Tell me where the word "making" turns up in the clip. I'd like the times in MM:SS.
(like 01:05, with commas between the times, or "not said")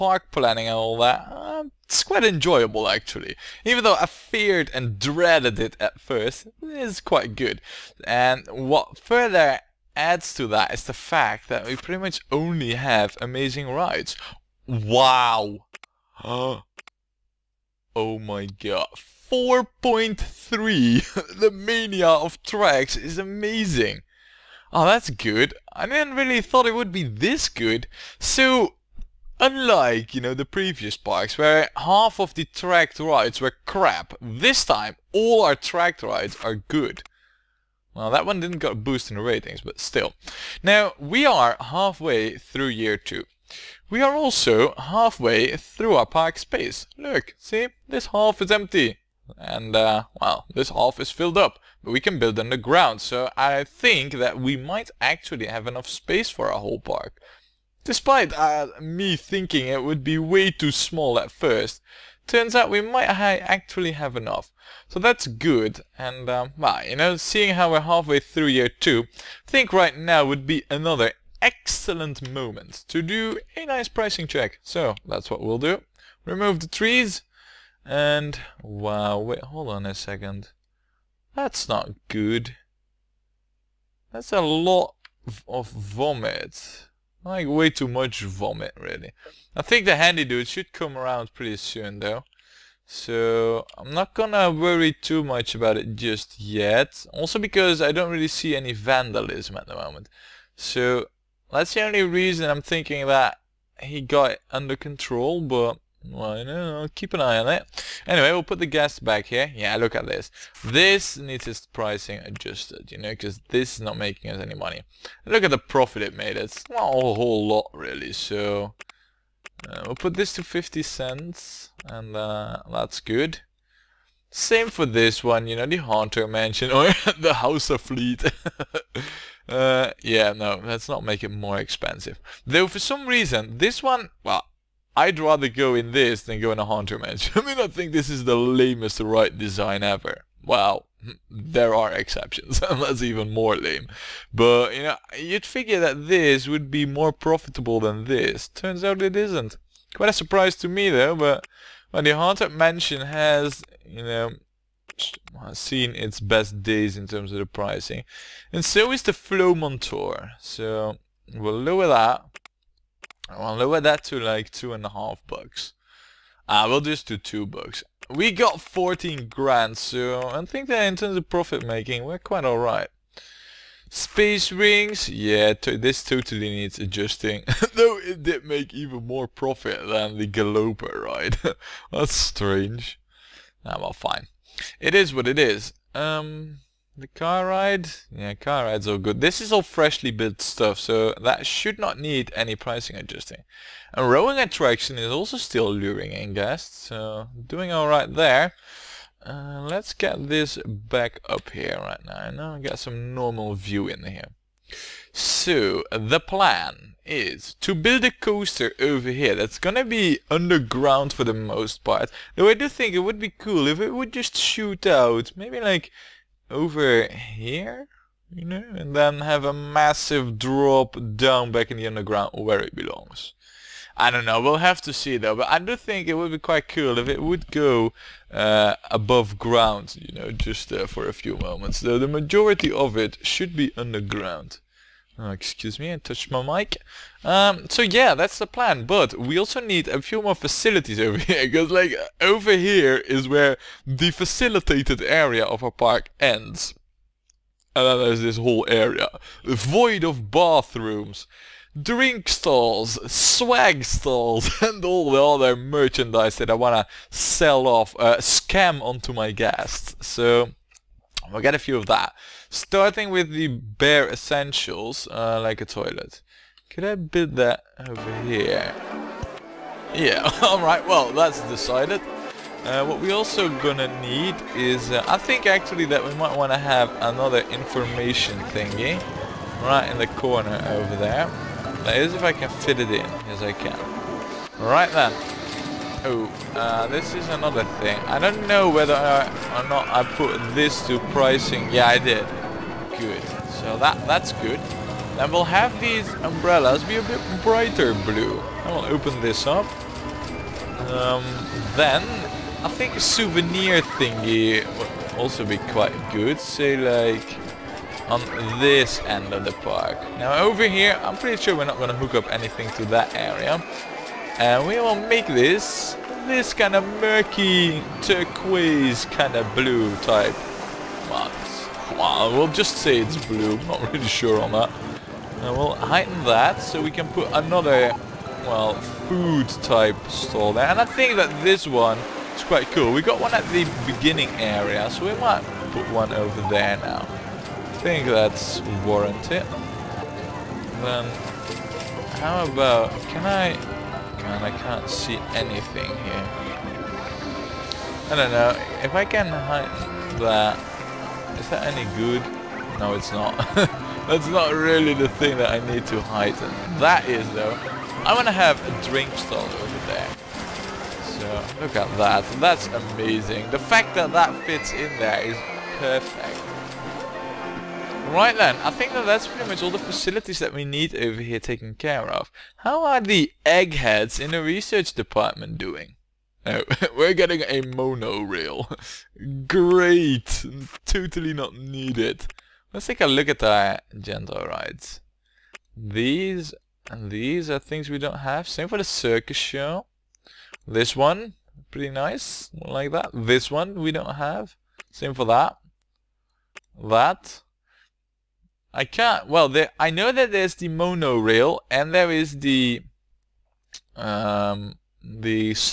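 01:53, 02:51.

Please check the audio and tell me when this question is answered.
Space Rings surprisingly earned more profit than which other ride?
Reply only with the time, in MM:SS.
03:00.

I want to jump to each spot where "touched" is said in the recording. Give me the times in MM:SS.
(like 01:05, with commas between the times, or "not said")
03:55.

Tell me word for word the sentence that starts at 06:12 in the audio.
How are the eggheads in the research department doing?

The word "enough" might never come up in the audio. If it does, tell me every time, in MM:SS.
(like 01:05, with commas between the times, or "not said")
00:55, 01:04.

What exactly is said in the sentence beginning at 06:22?
Let's take a look at our gentle rides.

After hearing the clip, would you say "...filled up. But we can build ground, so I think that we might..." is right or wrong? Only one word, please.
wrong.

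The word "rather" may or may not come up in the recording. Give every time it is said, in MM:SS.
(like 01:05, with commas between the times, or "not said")
02:15.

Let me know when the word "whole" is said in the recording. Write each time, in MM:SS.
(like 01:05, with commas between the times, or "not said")
00:56, 01:56, 04:08.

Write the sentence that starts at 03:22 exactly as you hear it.
Now I got some normal view in here.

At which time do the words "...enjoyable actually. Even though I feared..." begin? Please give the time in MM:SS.
00:02.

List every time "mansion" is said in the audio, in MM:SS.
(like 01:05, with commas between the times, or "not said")
02:06, 02:16, 02:32.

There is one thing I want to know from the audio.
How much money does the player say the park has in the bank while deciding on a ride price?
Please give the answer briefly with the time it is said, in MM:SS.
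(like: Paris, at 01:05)
14 grand, at 02:48.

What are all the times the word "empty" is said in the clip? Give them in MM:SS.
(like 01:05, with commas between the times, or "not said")
00:48.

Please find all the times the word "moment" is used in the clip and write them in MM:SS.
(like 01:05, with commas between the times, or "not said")
01:12, 01:39, 03:51.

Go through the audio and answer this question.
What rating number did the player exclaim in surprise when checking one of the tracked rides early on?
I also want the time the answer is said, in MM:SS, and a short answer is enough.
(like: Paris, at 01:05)
4.3, at 00:19.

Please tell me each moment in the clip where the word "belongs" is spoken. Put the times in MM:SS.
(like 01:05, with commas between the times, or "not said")
03:42.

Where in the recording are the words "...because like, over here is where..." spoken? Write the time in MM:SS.
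04:01.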